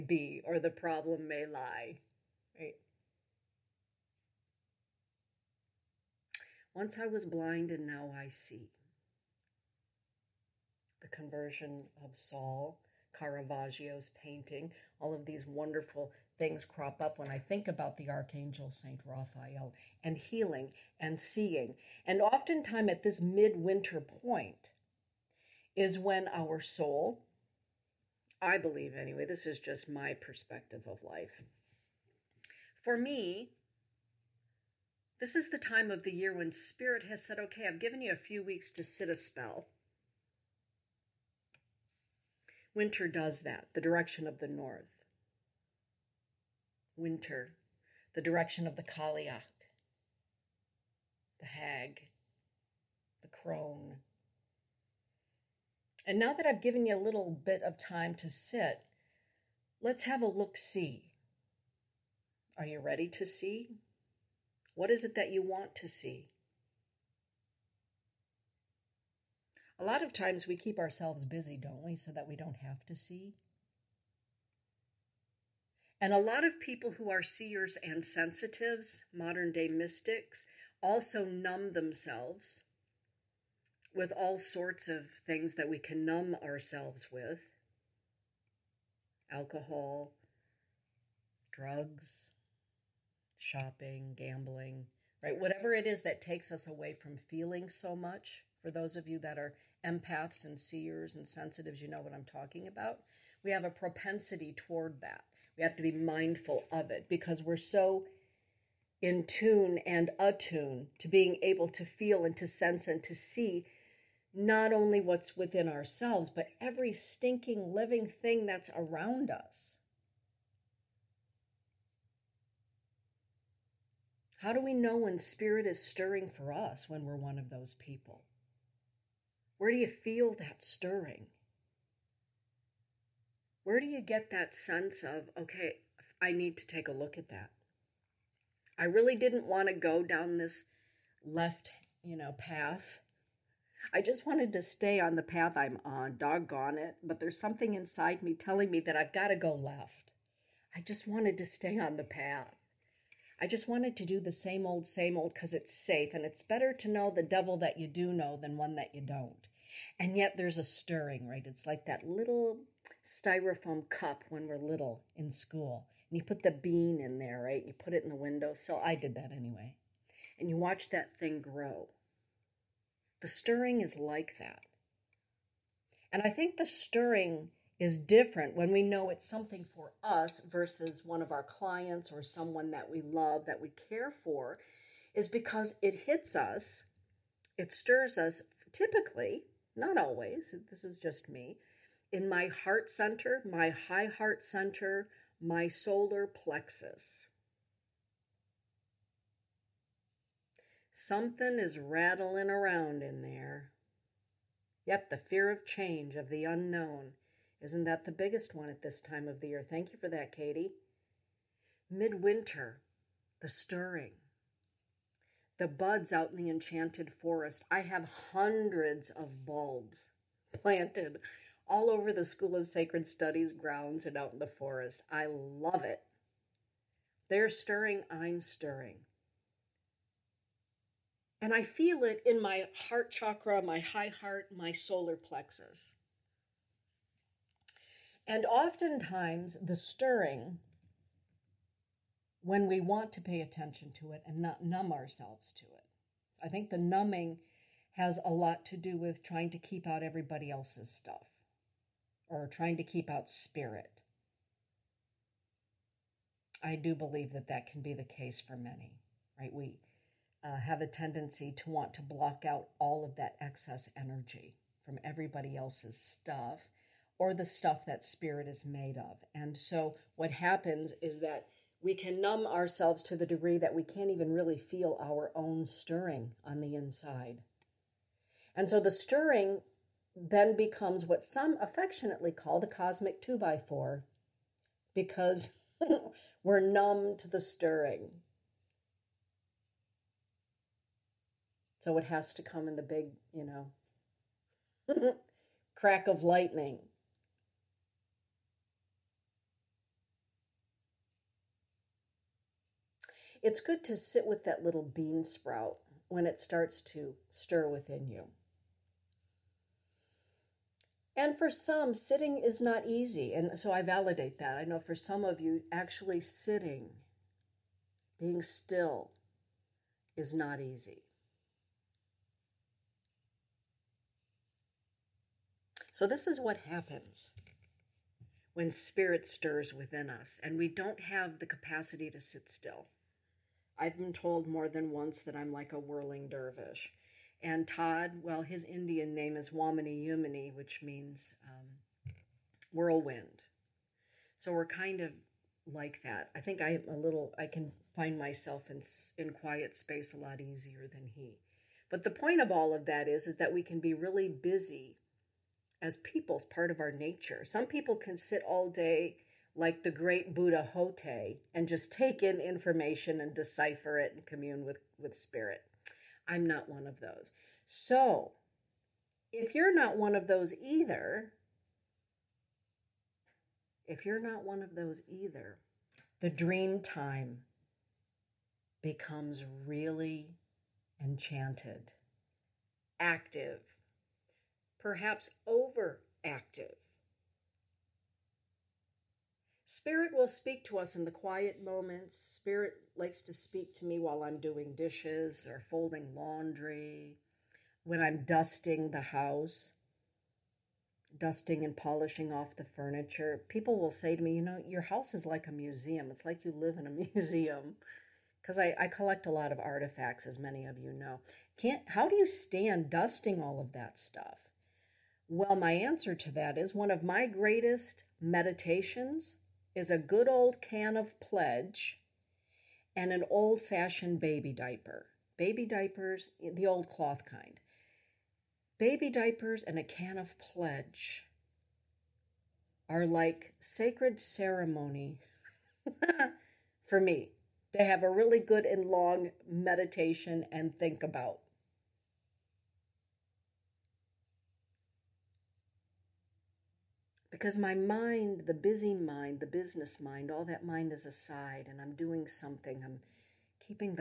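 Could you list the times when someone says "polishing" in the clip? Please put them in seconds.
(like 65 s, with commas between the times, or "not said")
401 s.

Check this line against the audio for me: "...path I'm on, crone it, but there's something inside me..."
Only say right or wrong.
wrong.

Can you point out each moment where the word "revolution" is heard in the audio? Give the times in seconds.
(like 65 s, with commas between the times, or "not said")
not said.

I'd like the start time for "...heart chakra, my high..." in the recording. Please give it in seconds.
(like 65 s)
232 s.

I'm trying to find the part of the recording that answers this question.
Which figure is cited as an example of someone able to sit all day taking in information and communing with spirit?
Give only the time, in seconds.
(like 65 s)
360 s.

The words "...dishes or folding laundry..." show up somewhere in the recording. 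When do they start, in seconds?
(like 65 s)
394 s.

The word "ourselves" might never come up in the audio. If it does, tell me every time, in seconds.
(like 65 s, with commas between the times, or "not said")
70 s, 86 s, 115 s, 244 s, 272 s.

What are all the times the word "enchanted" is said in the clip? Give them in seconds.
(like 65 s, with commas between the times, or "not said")
216 s, 381 s.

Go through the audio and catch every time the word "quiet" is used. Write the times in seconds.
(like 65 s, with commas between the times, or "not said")
349 s, 391 s.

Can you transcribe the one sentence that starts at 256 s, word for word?
I do believe that that can be the case for many, right?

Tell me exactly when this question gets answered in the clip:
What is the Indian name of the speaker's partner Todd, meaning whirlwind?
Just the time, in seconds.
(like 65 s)
339 s.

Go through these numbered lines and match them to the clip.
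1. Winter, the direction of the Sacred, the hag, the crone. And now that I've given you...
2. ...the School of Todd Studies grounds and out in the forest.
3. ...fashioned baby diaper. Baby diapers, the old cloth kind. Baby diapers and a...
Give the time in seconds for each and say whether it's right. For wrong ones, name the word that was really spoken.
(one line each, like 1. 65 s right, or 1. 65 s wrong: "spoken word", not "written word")
1. 46 s wrong: "Cailleach", not "Sacred"
2. 222 s wrong: "Sacred", not "Todd"
3. 423 s right.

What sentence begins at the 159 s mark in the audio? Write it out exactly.
And yet there's a stirring, right?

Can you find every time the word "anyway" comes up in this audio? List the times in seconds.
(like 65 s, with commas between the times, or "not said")
28 s, 169 s.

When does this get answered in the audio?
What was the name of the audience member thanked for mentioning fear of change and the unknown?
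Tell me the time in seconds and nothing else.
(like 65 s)
210 s.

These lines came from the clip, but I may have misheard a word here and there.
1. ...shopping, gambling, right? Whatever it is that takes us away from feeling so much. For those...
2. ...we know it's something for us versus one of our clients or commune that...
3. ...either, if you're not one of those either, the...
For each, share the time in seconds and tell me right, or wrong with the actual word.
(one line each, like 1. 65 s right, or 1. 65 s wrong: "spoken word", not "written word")
1. 93 s right
2. 178 s wrong: "someone", not "commune"
3. 370 s right.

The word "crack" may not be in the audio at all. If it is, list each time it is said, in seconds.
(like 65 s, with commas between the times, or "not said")
295 s.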